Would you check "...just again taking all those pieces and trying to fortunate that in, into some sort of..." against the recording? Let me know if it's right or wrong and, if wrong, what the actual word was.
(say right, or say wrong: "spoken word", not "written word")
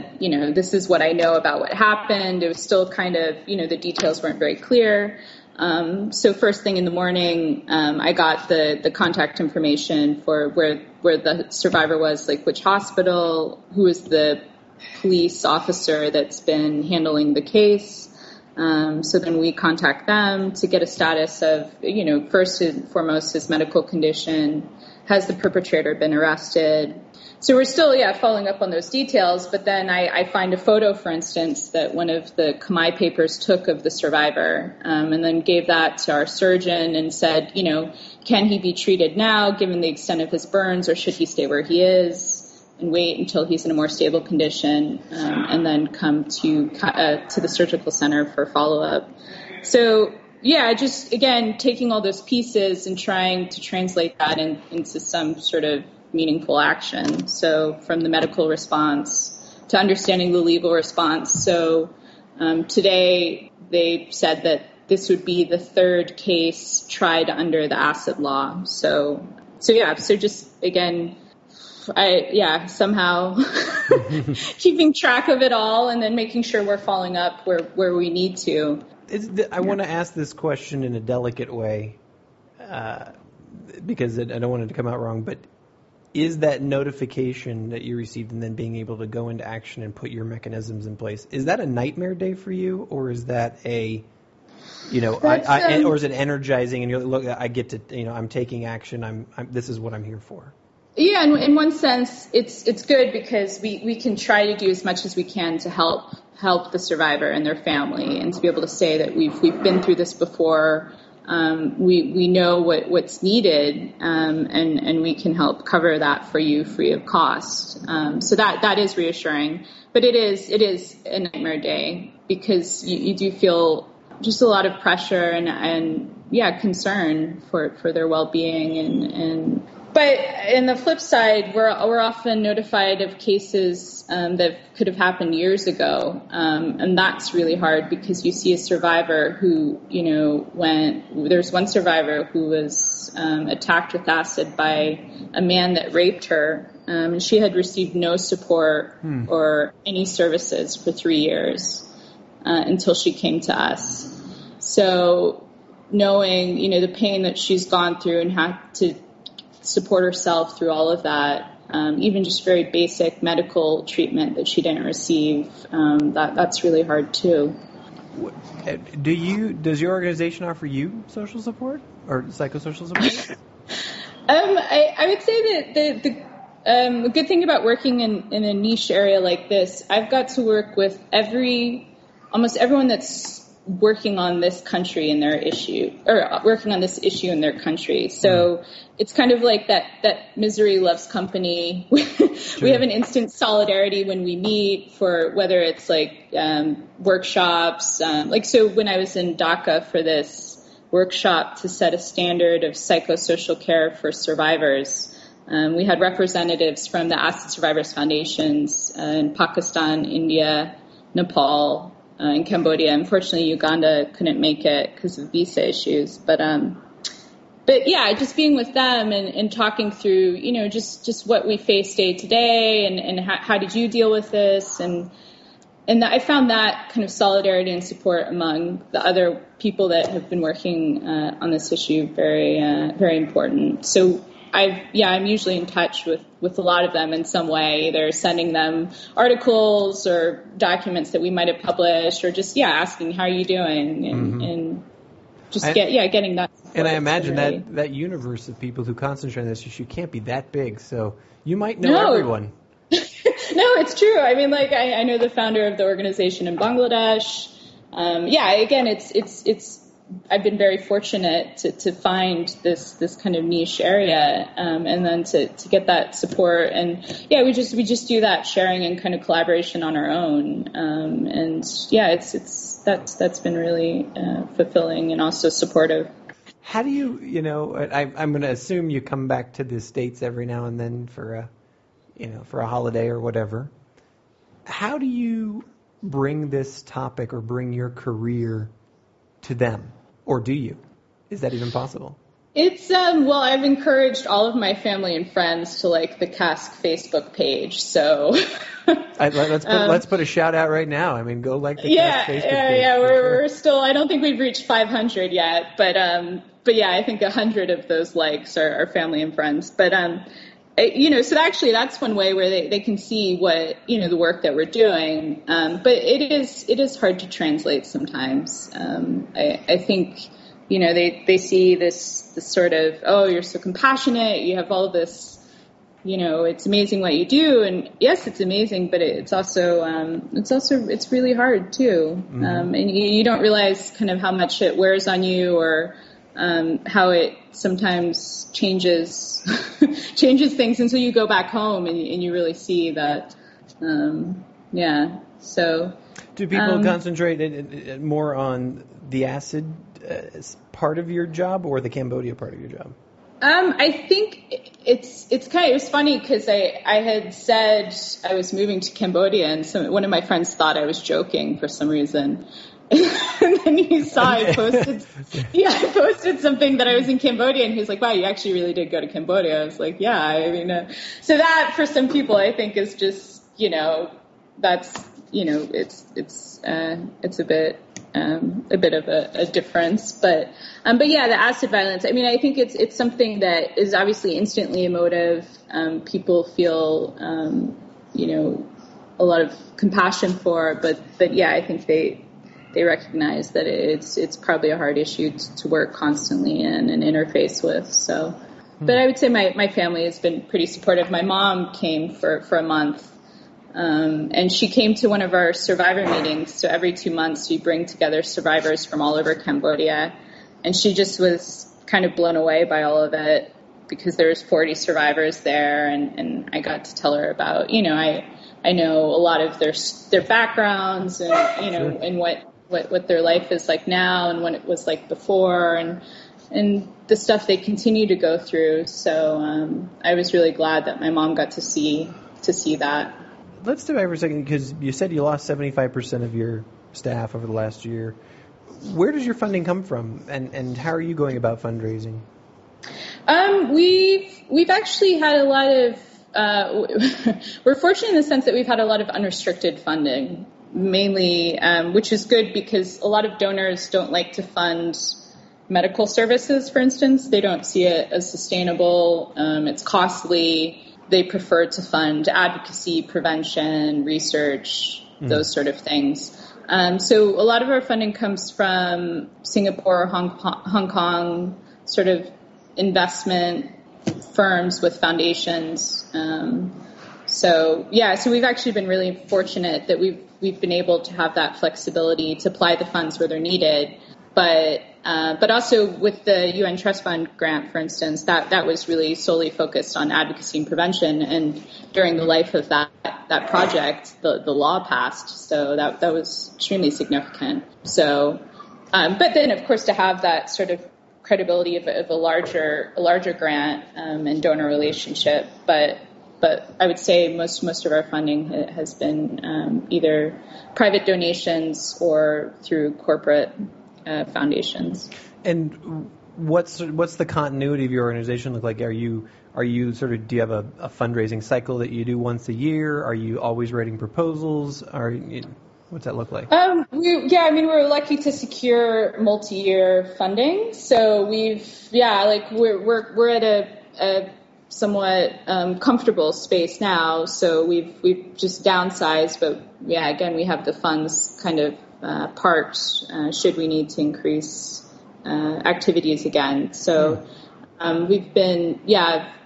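wrong: "translate", not "fortunate".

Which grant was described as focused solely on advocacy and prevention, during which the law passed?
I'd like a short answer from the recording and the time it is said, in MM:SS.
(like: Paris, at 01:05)
UN Trust Fund, at 08:06.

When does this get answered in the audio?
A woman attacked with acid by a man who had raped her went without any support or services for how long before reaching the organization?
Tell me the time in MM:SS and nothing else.
02:30.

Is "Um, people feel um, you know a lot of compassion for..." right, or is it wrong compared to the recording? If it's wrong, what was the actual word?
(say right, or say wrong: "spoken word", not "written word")
right.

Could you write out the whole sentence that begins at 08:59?
But yeah, again, we have the funds kind of uh, parked uh, should we need to increase uh, activities again.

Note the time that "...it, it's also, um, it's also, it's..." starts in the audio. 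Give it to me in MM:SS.
05:29.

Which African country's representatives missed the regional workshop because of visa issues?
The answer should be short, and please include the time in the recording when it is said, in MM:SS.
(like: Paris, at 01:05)
Uganda, at 03:33.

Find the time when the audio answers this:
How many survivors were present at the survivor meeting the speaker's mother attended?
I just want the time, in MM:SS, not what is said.
06:54.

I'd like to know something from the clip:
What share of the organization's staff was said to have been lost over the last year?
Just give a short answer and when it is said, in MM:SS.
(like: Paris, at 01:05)
75%, at 07:15.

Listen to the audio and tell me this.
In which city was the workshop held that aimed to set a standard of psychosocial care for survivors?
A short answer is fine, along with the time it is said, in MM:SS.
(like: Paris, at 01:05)
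Dhaka, at 03:19.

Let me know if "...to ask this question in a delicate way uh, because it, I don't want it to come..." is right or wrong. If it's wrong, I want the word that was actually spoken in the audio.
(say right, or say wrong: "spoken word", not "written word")
right.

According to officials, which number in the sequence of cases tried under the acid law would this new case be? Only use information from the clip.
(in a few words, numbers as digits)
third.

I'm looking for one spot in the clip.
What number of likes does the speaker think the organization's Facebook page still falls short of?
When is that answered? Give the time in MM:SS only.
05:04.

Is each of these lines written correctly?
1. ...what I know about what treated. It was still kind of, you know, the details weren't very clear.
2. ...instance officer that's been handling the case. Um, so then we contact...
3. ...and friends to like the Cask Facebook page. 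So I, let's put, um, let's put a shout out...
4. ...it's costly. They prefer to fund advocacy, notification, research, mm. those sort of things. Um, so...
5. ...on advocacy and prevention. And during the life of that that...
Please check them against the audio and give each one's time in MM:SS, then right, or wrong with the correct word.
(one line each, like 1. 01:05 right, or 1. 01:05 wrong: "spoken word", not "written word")
1. 00:00 wrong: "happened", not "treated"
2. 00:15 wrong: "police", not "instance"
3. 04:55 right
4. 07:39 wrong: "prevention", not "notification"
5. 08:09 right.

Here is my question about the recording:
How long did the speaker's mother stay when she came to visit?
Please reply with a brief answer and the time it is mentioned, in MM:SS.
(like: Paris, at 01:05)
a month, at 06:42.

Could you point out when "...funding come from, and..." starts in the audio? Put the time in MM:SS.
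07:19.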